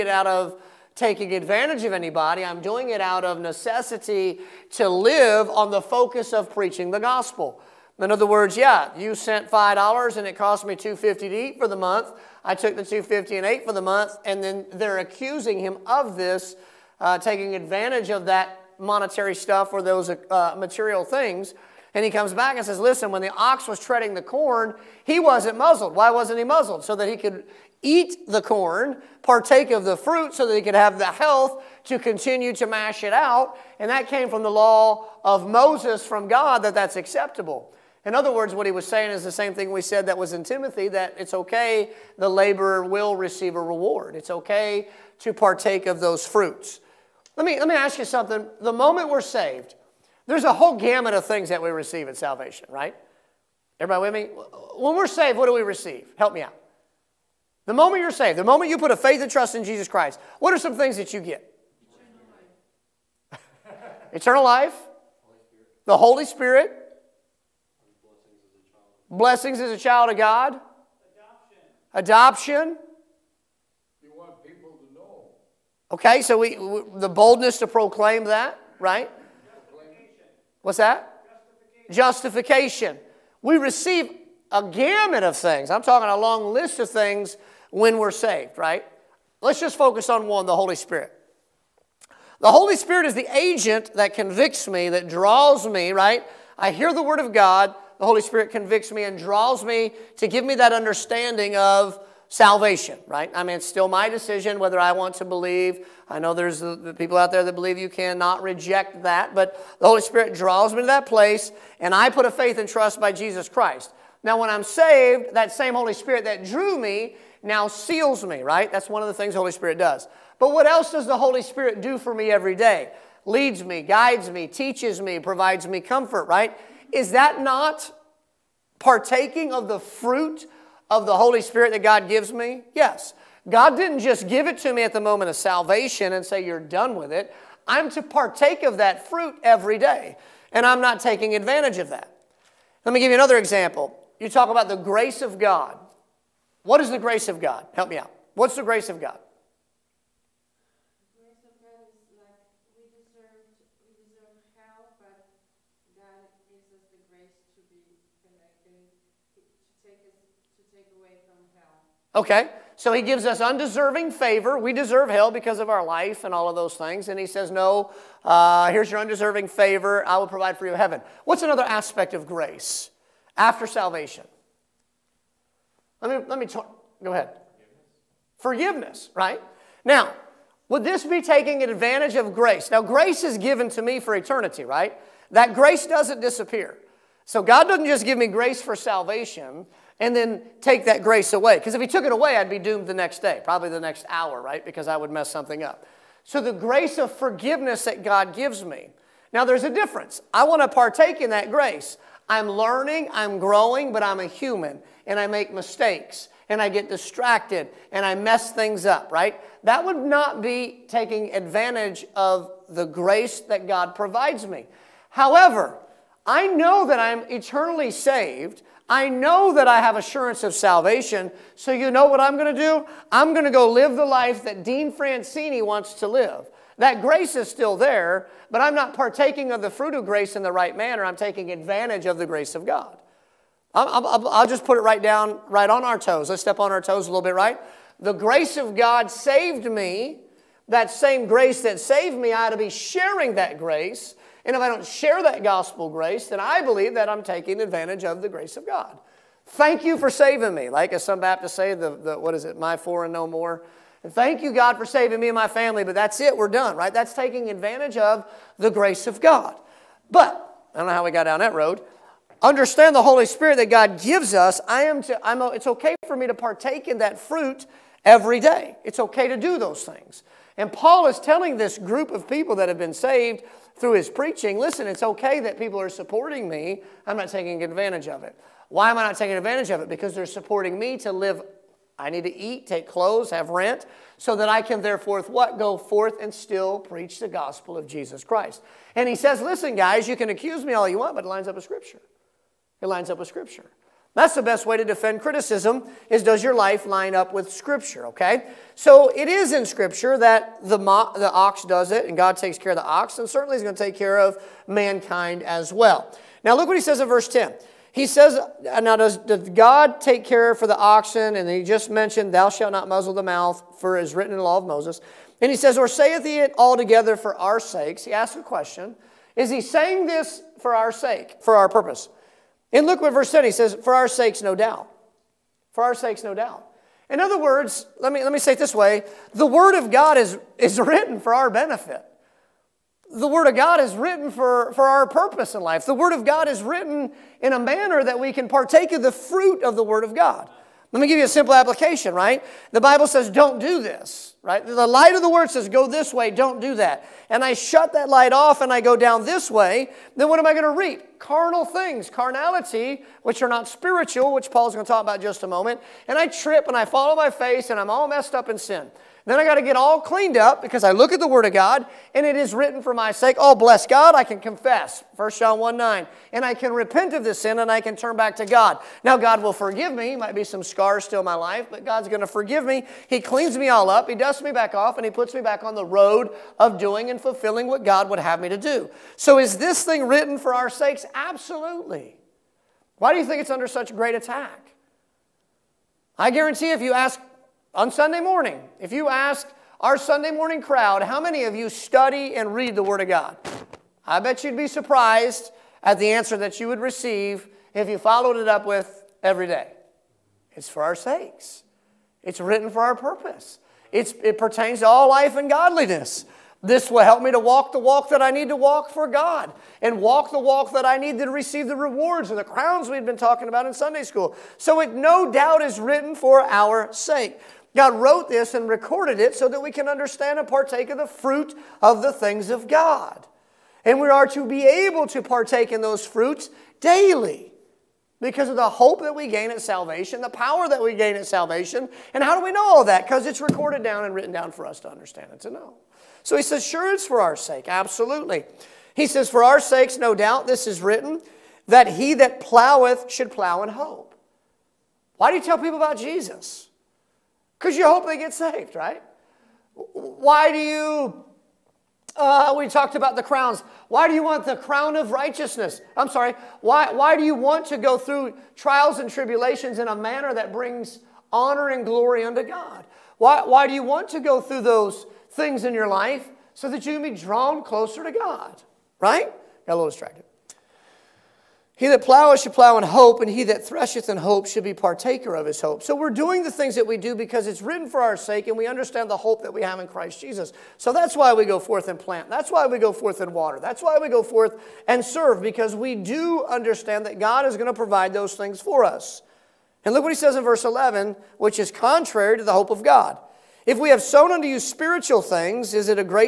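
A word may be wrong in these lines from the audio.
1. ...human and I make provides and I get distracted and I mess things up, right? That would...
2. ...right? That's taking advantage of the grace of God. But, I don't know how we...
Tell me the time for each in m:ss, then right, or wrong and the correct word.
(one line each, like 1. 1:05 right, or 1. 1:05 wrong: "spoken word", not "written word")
1. 3:24 wrong: "mistakes", not "provides"
2. 4:16 right.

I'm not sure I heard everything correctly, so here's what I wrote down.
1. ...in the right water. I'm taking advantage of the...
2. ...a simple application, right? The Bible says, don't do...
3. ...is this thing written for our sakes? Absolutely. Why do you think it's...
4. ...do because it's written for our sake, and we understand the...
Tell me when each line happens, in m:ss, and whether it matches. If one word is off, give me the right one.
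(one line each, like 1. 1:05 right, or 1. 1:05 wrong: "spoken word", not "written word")
1. 3:50 wrong: "manner", not "water"
2. 5:41 right
3. 6:19 right
4. 7:56 right.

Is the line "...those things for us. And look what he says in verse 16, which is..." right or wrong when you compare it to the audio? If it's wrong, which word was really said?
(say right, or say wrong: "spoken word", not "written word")
wrong: "11", not "16".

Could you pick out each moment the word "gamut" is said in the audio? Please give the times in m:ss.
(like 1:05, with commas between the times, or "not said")
0:50, 1:24.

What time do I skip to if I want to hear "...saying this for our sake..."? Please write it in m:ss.
5:19.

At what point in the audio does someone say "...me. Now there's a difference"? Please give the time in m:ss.
3:18.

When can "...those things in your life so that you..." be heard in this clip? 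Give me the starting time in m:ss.
7:44.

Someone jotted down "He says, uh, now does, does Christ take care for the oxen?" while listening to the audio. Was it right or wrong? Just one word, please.
wrong.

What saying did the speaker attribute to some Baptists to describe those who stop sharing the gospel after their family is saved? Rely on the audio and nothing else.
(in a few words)
my four and no more.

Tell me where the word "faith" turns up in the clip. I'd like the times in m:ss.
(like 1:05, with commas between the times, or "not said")
0:58, 1:52.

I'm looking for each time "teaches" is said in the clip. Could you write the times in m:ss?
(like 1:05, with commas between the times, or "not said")
2:04.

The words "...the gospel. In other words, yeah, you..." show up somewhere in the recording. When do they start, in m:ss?
0:06.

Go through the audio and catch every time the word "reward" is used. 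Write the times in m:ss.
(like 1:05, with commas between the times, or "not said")
0:43, 6:51.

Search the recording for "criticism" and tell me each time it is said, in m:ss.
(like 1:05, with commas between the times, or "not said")
4:55.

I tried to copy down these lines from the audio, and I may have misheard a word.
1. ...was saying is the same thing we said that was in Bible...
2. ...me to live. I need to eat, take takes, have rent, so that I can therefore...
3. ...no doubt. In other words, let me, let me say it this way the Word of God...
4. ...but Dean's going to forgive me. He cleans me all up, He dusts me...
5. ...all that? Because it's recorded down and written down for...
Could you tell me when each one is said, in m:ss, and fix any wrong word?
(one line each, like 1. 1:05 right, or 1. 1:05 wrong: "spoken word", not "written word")
1. 0:38 wrong: "Timothy", not "Bible"
2. 4:40 wrong: "clothes", not "takes"
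3. 5:26 right
4. 6:11 wrong: "God", not "Dean"
5. 7:12 right.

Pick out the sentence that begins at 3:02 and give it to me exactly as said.
Now, grace is given to me for eternity, right?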